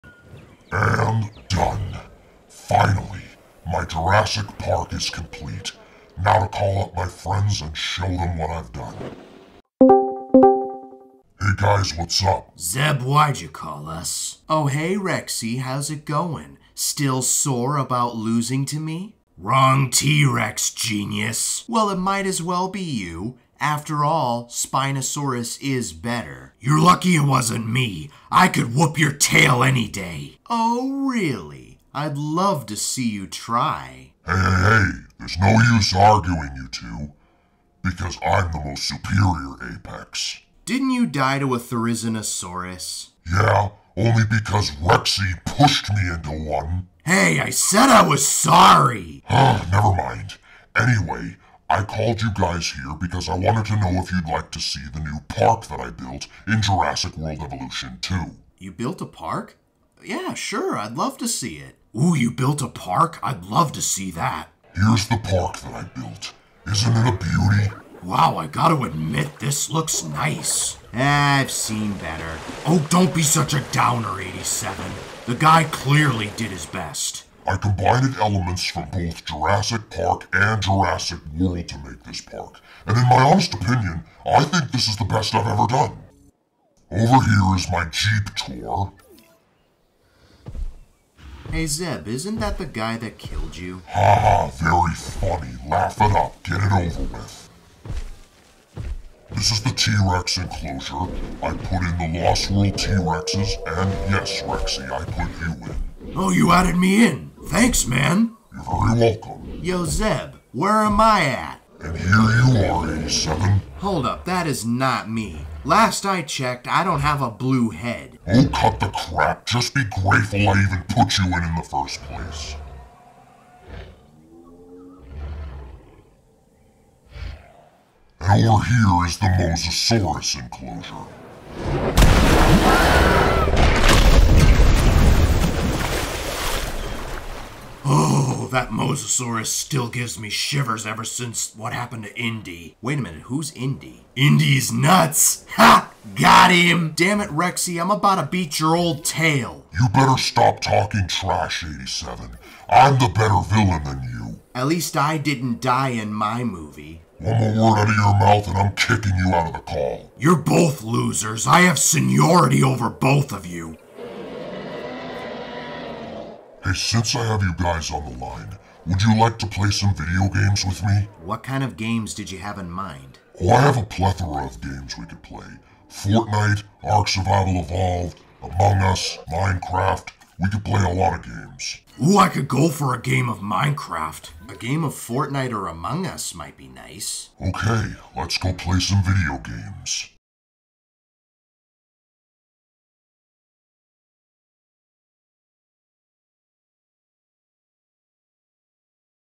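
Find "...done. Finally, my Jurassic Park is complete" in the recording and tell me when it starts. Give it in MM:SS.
00:01.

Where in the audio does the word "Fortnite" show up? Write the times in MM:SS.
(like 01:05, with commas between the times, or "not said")
02:55, 03:04.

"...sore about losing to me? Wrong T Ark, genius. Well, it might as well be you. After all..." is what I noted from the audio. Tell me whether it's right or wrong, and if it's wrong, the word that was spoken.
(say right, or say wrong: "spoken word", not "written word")
wrong: "Rex", not "Ark".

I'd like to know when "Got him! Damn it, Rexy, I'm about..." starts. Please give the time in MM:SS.
02:26.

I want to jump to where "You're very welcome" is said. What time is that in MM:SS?
01:48.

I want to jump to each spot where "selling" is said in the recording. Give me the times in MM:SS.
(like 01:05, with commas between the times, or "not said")
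not said.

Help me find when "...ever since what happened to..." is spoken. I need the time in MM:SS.
02:20.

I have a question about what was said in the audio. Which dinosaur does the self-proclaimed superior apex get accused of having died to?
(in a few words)
Therizinosaurus.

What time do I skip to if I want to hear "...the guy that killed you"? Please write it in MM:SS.
01:32.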